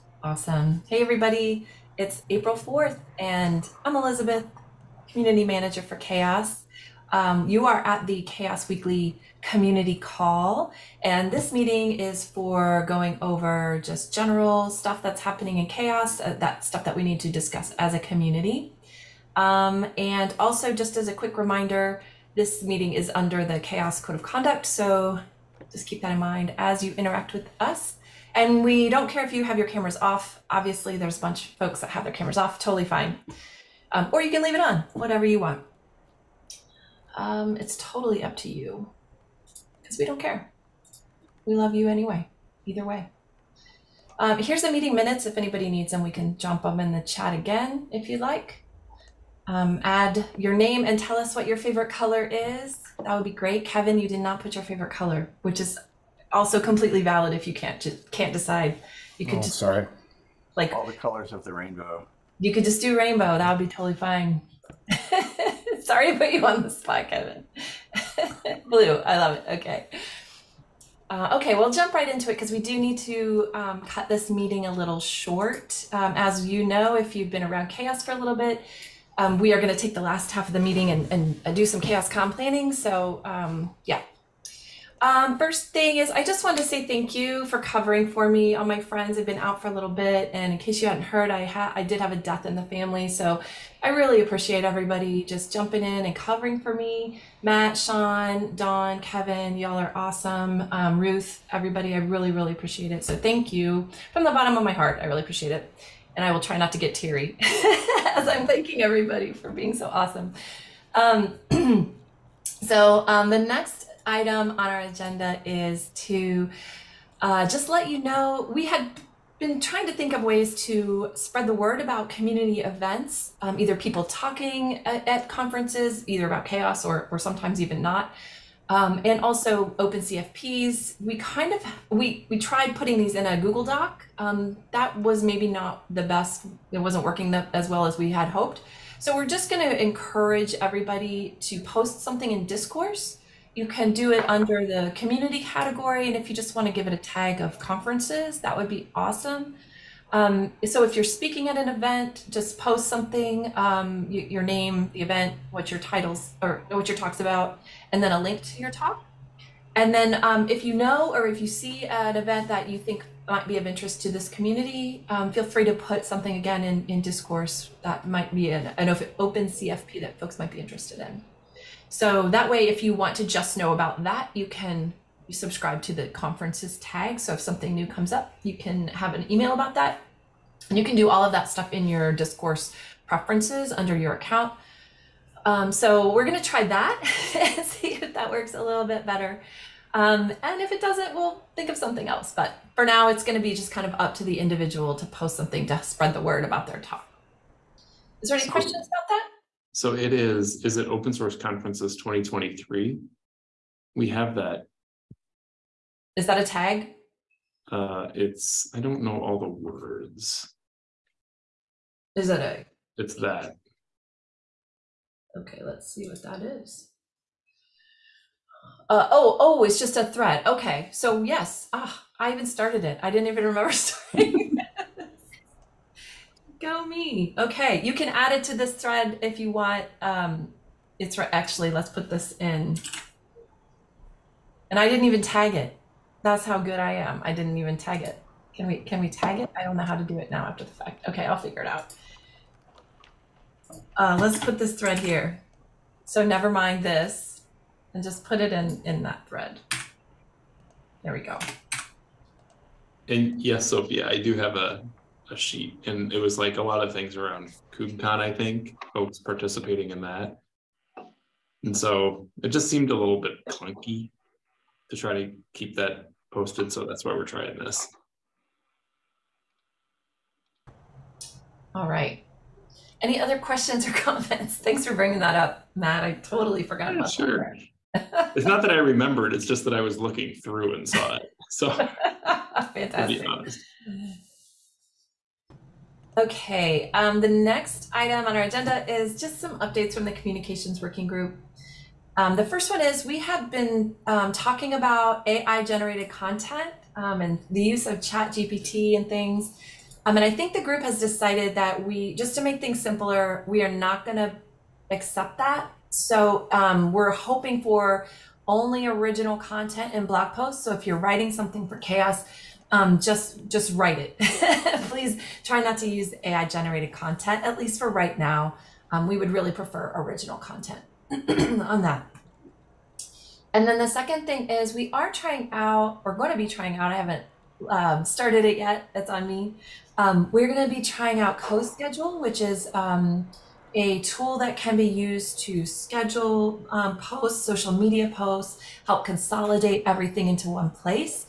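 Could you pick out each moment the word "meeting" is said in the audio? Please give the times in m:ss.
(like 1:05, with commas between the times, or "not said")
0:11, 0:22, 0:44, 1:14, 1:20.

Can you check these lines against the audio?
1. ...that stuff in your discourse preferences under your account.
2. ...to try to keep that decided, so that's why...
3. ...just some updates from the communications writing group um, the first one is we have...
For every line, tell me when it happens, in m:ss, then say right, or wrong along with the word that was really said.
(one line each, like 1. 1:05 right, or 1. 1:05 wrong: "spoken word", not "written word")
1. 3:01 right
2. 4:24 wrong: "posted", not "decided"
3. 4:49 wrong: "working", not "writing".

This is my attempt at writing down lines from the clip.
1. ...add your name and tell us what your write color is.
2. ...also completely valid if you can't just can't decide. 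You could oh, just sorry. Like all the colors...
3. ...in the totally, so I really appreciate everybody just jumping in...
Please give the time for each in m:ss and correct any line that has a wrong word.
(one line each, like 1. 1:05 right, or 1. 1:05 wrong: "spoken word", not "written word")
1. 0:49 wrong: "favorite", not "write"
2. 0:56 right
3. 1:32 wrong: "family", not "totally".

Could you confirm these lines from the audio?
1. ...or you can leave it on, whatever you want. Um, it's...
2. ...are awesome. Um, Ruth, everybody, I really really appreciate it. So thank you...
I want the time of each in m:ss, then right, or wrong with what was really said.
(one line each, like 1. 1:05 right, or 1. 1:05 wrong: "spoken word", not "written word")
1. 0:34 right
2. 1:39 right.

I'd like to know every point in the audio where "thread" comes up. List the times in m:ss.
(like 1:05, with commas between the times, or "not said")
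3:40, 3:48, 4:04, 4:09.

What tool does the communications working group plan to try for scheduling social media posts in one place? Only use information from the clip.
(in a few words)
CoSchedule.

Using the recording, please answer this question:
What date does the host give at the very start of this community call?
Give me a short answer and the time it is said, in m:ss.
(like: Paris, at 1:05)
April 4th, at 0:02.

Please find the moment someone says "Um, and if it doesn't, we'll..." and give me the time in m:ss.
3:09.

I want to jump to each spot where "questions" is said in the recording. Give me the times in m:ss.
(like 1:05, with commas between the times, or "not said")
3:18, 4:33.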